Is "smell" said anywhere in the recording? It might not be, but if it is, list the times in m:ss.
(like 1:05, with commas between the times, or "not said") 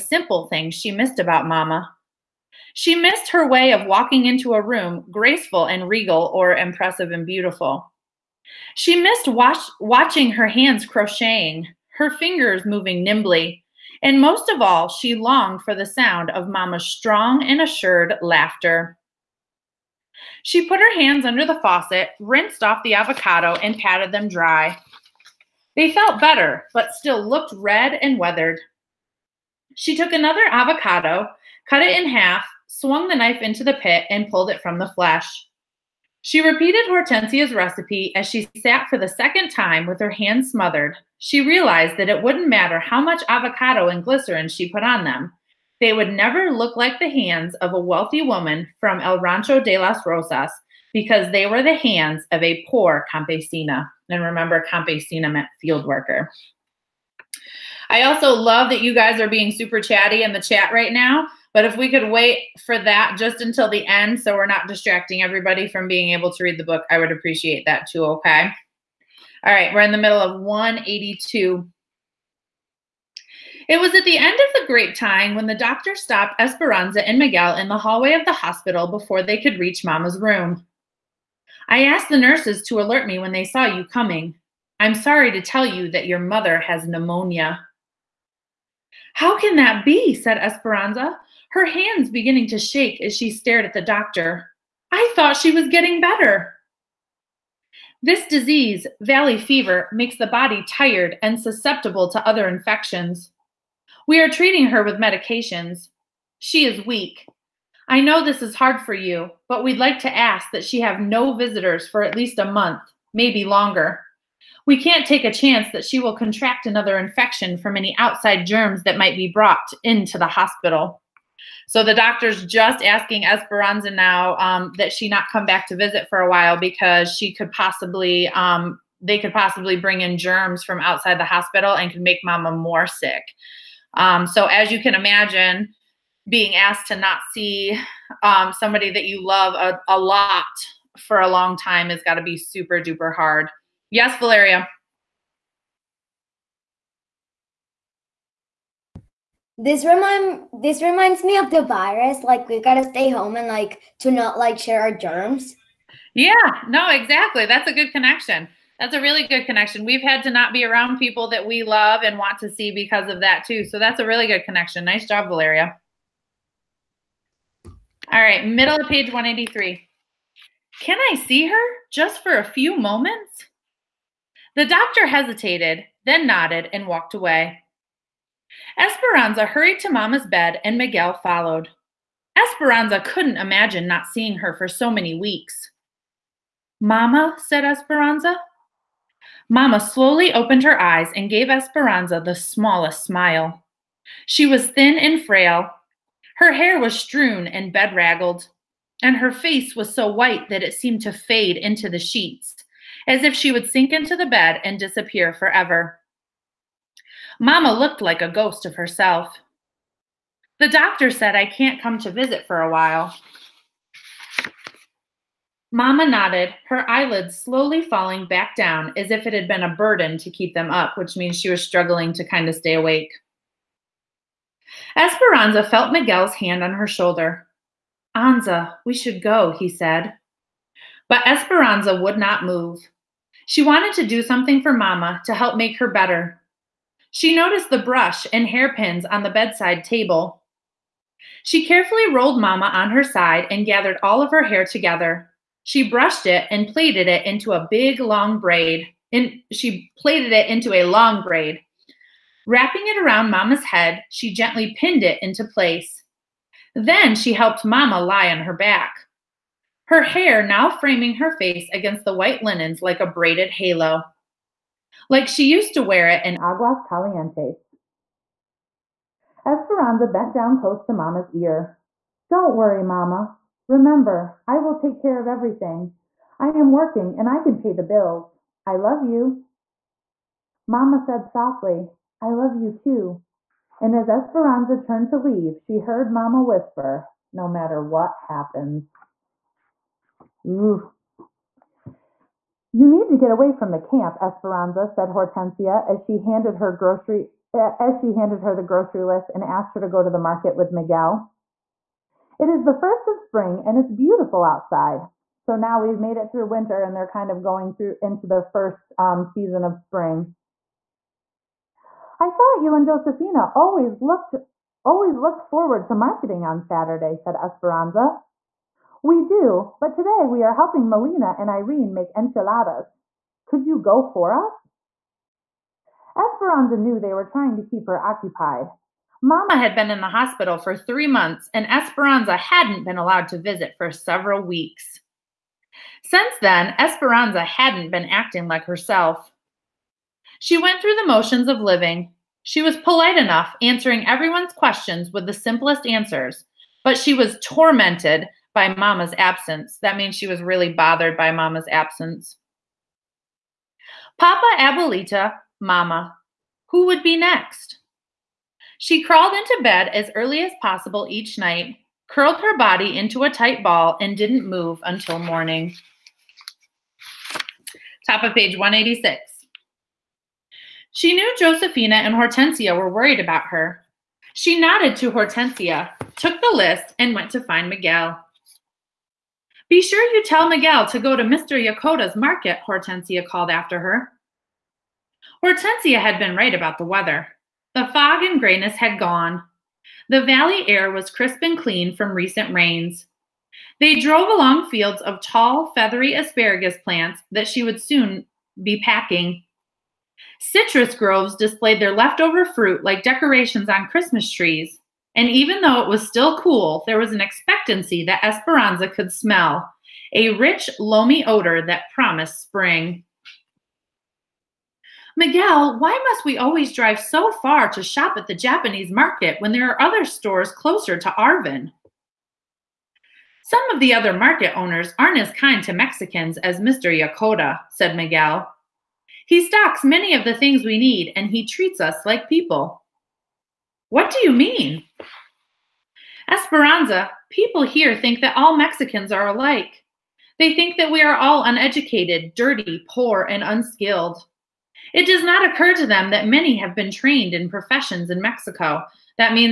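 6:49.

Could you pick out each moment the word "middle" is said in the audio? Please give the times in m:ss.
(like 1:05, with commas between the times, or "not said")
1:09, 2:48.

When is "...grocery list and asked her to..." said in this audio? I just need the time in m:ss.
4:58.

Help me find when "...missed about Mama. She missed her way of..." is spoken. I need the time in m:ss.
0:00.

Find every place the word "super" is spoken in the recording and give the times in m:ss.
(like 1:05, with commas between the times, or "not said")
0:59, 2:22.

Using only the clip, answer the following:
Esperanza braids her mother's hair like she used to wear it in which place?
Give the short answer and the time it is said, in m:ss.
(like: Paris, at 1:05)
Aguas Calientes, at 4:26.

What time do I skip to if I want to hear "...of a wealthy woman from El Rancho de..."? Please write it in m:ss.
0:47.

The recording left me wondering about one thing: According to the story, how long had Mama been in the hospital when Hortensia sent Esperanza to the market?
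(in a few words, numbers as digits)
3 months.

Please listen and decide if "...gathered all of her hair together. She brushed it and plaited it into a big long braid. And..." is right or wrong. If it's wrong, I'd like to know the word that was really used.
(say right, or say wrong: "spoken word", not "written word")
right.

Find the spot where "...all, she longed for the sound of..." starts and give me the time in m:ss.
0:14.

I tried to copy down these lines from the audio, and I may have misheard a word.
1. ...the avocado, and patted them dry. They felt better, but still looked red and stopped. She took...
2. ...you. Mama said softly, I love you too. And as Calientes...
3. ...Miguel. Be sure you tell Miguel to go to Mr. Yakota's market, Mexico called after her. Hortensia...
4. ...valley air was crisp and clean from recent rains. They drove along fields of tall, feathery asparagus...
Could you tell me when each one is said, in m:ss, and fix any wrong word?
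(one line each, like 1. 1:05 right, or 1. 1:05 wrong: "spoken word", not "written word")
1. 0:22 wrong: "weathered", not "stopped"
2. 4:39 wrong: "Esperanza", not "Calientes"
3. 6:17 wrong: "Hortensia", not "Mexico"
4. 6:30 right.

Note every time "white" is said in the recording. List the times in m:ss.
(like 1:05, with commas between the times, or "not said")
3:20, 4:22.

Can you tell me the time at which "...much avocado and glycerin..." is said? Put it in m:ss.
0:42.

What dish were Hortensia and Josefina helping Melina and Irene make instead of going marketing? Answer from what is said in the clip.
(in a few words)
enchiladas.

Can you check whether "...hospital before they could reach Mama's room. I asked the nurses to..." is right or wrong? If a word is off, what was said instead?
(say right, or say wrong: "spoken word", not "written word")
right.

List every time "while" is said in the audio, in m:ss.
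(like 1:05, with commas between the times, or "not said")
2:06, 3:32.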